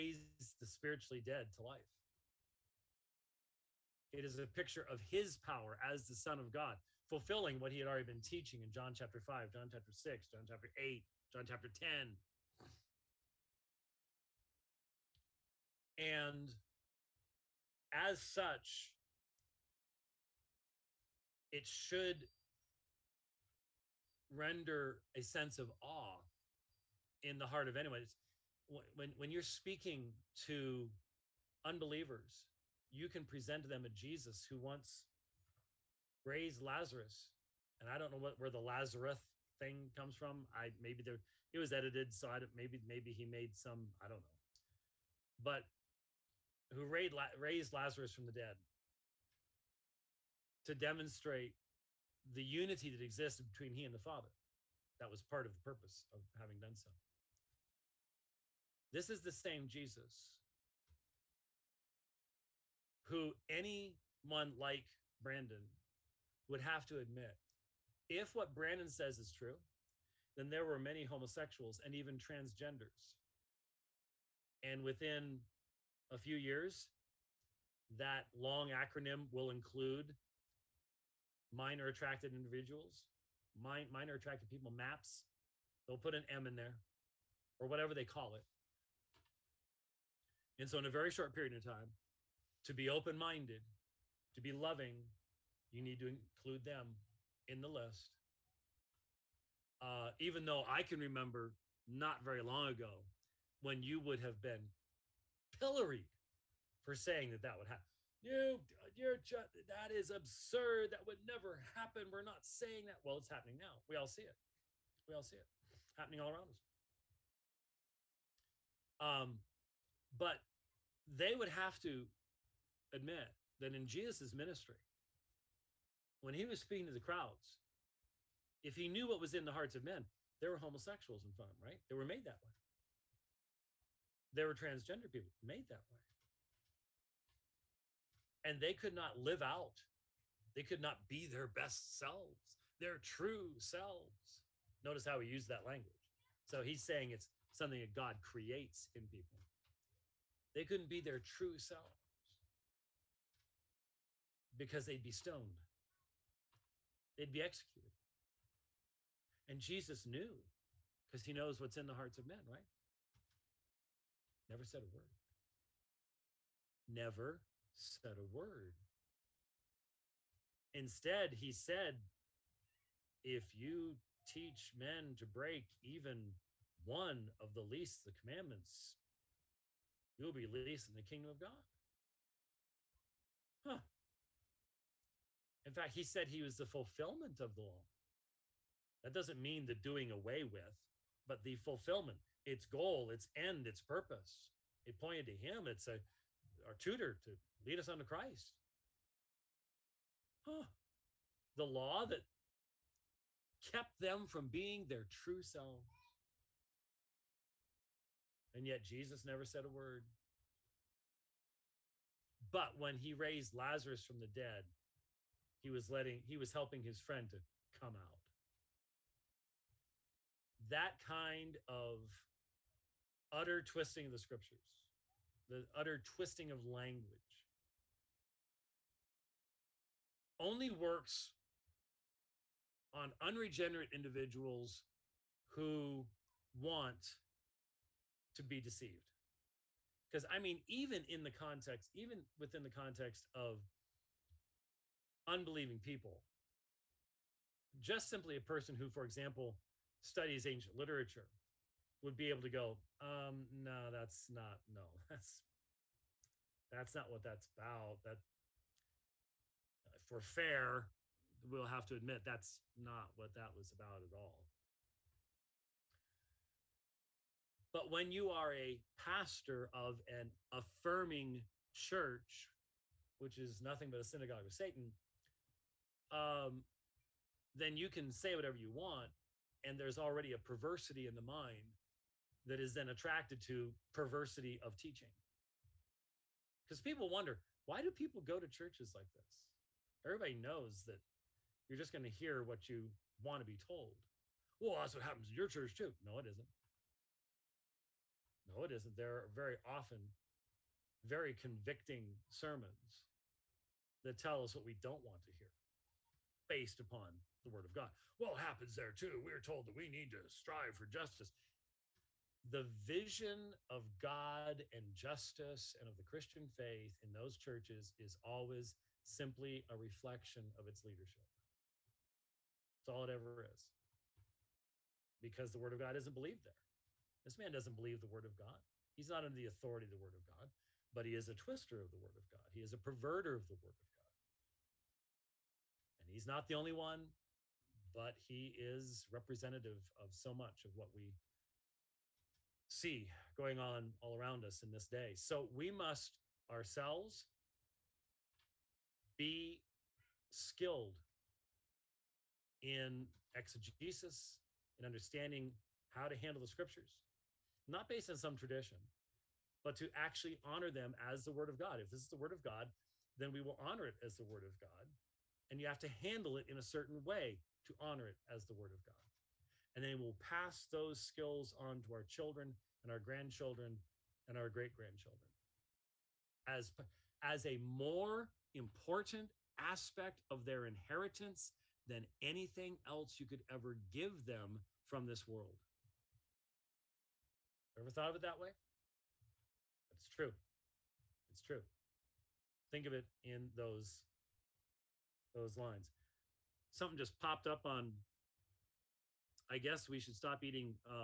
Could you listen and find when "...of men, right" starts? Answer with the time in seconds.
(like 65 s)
162 s.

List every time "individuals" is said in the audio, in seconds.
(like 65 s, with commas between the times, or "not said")
82 s, 233 s.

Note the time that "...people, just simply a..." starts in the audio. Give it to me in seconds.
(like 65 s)
245 s.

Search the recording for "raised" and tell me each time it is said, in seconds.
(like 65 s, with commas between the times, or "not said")
36 s, 46 s, 213 s.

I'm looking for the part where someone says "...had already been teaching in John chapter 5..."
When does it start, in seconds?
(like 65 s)
7 s.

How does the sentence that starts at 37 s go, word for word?
And I don't know what where the Lazarus thing comes from.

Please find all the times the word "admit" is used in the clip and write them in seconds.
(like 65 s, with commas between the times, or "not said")
66 s, 122 s, 261 s.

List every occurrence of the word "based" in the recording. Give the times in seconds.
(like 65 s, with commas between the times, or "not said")
306 s, 357 s.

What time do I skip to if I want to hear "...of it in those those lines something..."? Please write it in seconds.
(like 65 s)
392 s.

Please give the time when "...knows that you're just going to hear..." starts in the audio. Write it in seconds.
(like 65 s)
290 s.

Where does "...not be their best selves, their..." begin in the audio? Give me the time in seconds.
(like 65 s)
140 s.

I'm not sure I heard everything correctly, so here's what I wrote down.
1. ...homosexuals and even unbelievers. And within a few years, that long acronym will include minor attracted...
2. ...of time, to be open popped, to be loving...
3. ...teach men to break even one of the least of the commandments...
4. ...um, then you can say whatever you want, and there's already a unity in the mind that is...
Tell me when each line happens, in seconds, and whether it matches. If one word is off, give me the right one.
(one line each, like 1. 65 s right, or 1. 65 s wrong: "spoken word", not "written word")
1. 71 s wrong: "transgenders", not "unbelievers"
2. 91 s wrong: "minded", not "popped"
3. 174 s right
4. 276 s wrong: "perversity", not "unity".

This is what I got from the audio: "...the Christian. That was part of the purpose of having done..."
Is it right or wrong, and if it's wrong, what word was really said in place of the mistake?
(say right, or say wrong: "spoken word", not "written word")
wrong: "Father", not "Christian".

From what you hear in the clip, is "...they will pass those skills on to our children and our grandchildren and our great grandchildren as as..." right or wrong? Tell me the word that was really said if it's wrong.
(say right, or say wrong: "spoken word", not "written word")
right.